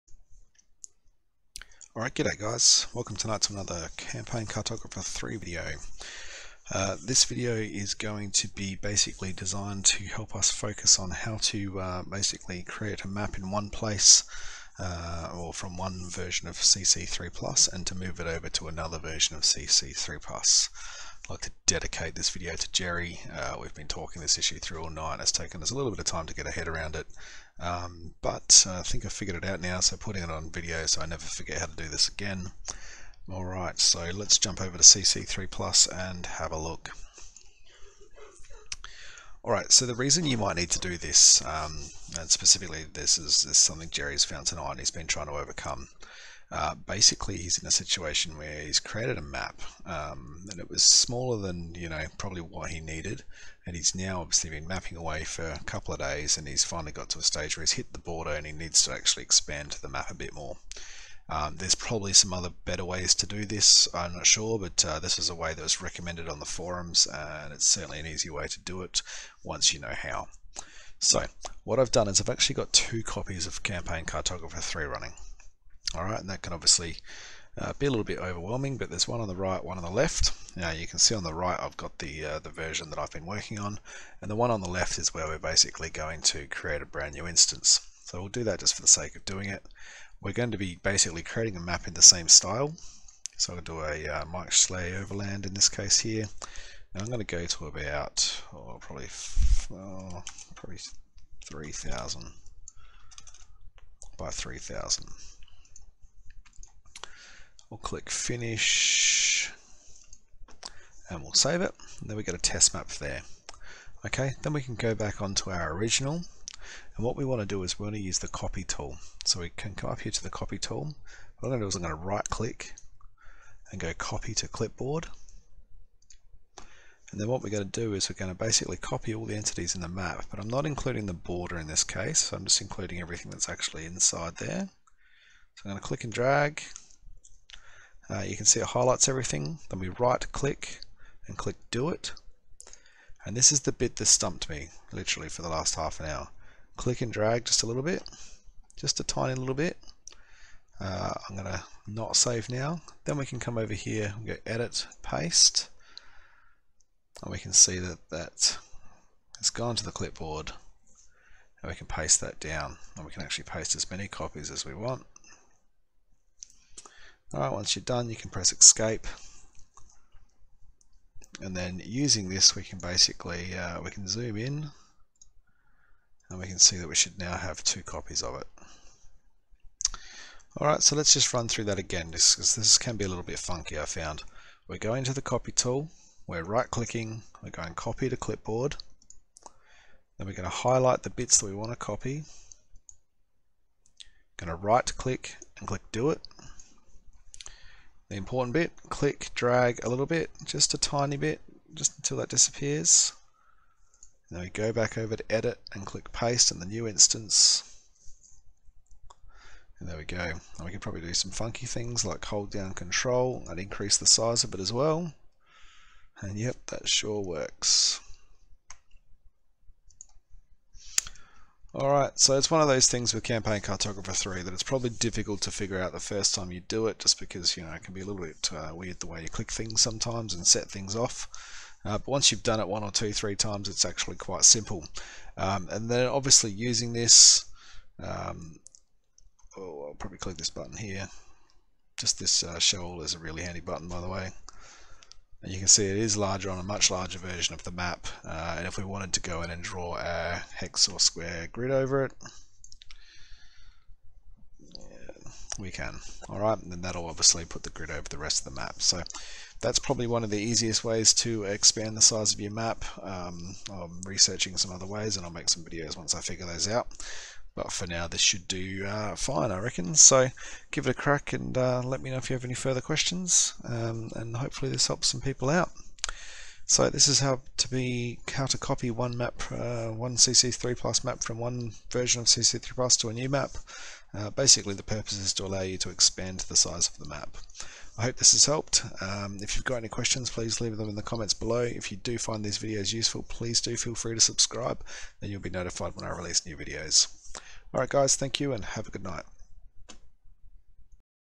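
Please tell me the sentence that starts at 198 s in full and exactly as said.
The important bit, click drag a little bit, just a tiny bit, just until that disappears.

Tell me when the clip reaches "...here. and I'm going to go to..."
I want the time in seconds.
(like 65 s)
95 s.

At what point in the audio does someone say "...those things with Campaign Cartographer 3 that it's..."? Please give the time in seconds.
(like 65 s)
222 s.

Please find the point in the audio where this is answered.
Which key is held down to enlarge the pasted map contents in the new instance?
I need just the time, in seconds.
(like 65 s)
212 s.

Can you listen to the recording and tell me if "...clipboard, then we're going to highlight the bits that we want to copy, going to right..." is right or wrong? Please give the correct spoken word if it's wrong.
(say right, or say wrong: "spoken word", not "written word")
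right.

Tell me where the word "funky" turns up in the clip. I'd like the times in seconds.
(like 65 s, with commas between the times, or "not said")
183 s, 211 s.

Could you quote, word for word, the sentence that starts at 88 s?
So we'll do that just for the sake of doing it.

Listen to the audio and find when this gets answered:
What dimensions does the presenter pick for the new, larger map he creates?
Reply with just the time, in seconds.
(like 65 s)
101 s.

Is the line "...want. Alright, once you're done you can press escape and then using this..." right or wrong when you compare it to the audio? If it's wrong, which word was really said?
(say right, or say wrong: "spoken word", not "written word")
right.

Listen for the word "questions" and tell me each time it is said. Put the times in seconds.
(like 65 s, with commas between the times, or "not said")
272 s, 289 s.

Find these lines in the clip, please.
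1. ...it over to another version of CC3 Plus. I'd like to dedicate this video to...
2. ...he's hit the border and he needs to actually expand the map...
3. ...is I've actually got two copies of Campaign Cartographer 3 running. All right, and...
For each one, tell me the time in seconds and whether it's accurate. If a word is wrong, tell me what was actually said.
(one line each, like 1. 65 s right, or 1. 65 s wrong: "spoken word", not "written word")
1. 18 s right
2. 57 s right
3. 72 s right.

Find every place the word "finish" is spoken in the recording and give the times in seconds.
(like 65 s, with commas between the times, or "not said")
108 s.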